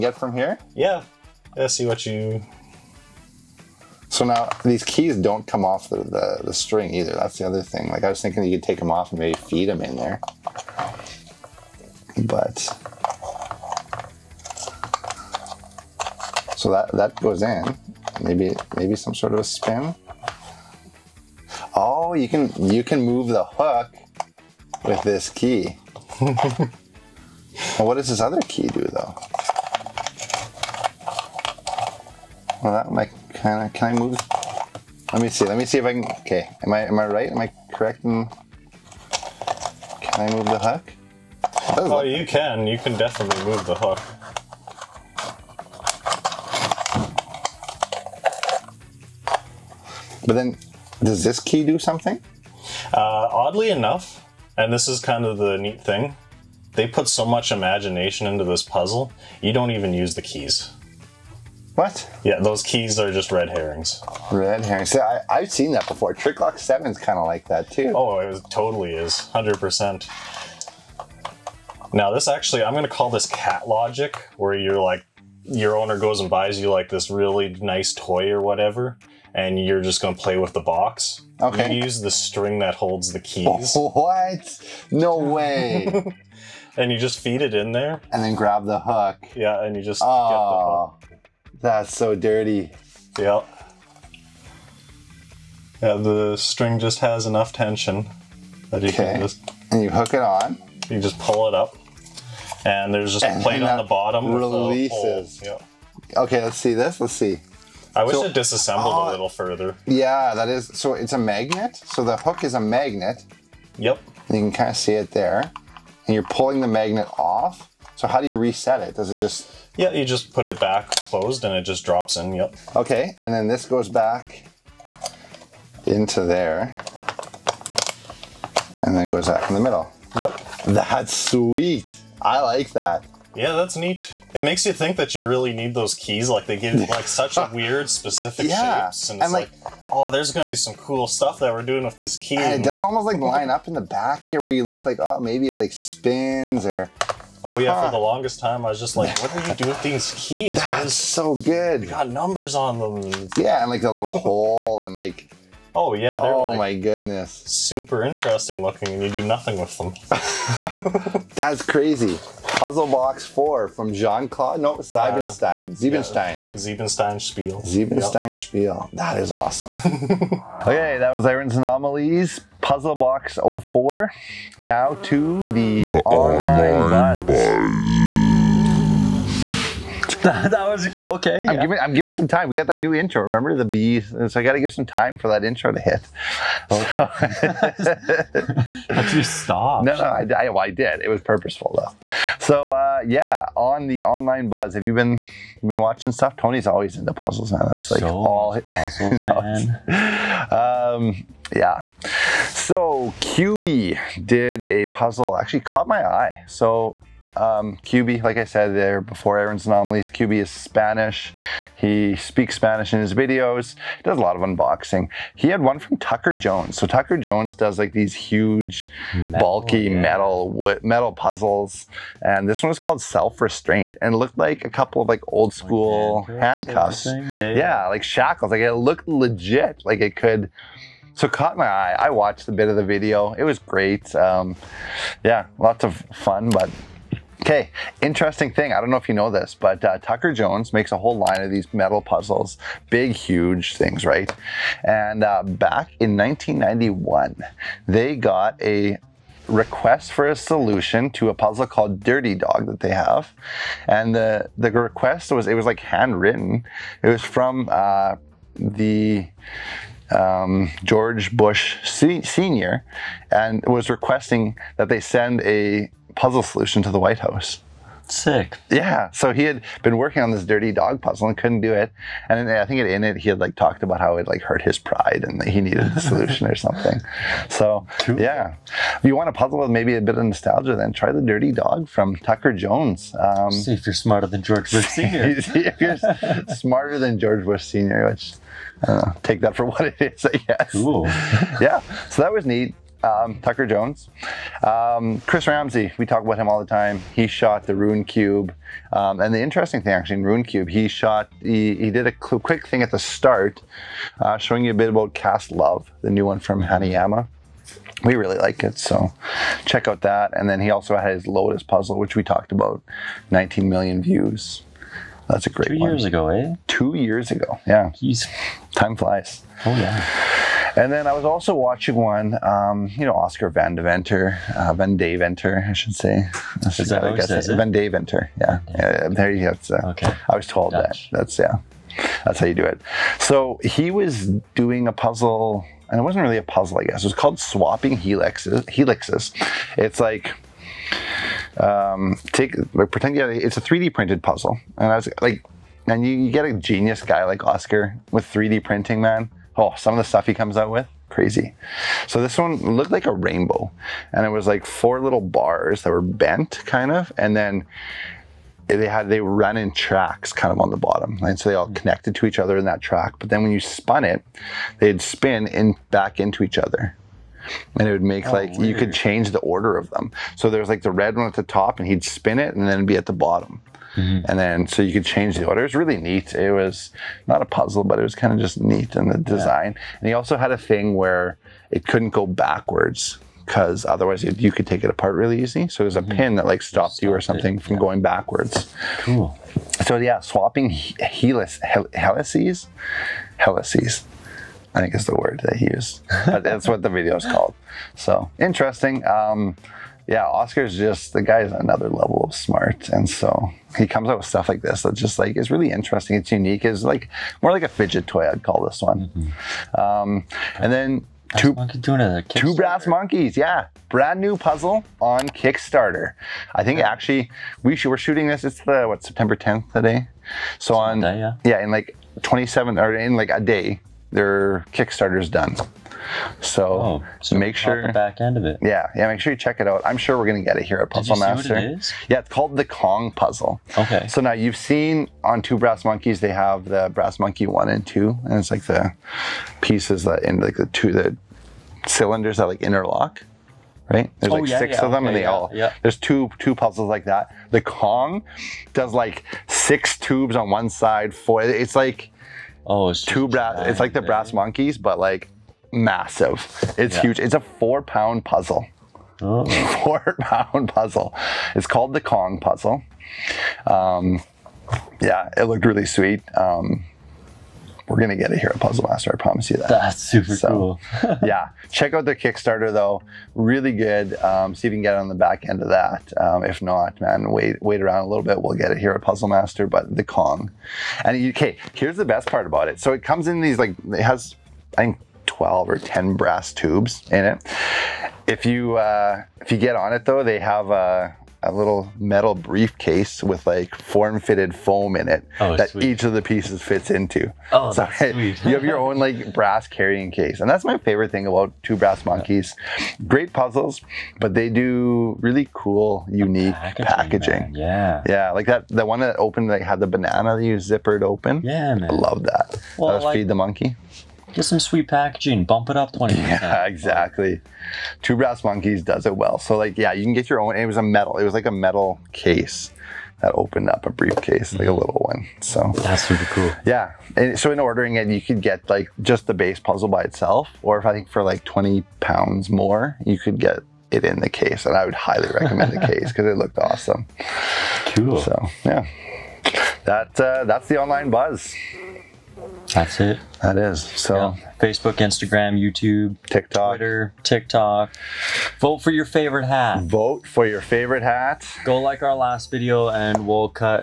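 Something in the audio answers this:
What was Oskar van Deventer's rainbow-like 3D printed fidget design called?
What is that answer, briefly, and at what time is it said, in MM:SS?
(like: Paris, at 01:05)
Swapping Helixes, at 05:37.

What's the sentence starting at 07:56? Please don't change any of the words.
Um, if not, man, wait wait around a little bit.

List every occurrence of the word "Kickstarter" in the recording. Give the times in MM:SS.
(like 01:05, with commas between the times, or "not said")
06:55, 07:04, 07:52.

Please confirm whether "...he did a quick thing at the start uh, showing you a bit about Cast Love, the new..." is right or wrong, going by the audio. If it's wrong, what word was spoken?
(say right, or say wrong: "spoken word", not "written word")
right.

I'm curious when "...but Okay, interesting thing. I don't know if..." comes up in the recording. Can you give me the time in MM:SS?
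03:56.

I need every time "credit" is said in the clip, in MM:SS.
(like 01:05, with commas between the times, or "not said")
not said.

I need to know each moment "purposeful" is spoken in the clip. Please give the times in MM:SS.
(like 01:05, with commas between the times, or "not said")
03:11.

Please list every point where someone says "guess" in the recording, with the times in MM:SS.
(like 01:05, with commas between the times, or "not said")
04:50, 05:27, 05:36.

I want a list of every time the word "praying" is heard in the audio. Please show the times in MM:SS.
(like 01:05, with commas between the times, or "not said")
not said.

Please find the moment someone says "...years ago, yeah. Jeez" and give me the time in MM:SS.
05:16.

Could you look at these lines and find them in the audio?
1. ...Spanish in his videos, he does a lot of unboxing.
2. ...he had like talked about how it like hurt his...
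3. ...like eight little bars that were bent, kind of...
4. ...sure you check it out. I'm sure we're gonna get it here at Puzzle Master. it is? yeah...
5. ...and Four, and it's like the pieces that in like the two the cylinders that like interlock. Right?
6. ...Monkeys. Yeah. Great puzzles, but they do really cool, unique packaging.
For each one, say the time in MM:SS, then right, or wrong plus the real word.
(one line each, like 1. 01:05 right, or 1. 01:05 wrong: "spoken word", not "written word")
1. 03:32 right
2. 04:33 right
3. 05:54 wrong: "four", not "eight"
4. 07:09 right
5. 07:17 wrong: "Two", not "Four"
6. 08:22 right.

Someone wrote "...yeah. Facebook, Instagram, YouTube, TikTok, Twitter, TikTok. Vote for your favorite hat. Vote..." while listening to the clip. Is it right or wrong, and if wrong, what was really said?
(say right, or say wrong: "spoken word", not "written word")
right.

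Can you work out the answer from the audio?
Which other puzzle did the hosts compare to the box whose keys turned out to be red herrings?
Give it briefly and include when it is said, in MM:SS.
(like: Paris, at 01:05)
Trick Lock 7, at 01:06.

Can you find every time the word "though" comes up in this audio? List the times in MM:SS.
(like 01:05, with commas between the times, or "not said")
00:28, 03:11, 07:52, 08:10.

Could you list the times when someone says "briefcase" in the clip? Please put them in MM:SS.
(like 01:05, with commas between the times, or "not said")
08:12, 08:43.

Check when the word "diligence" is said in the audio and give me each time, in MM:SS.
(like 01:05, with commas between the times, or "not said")
not said.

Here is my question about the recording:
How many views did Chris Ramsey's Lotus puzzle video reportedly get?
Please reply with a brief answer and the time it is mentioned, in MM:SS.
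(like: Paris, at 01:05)
19 million, at 05:13.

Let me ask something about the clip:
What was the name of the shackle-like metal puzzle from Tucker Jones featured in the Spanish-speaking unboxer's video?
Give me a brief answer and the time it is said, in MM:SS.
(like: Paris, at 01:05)
Self Restraint, at 03:43.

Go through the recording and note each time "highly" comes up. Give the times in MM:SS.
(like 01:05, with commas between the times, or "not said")
08:54.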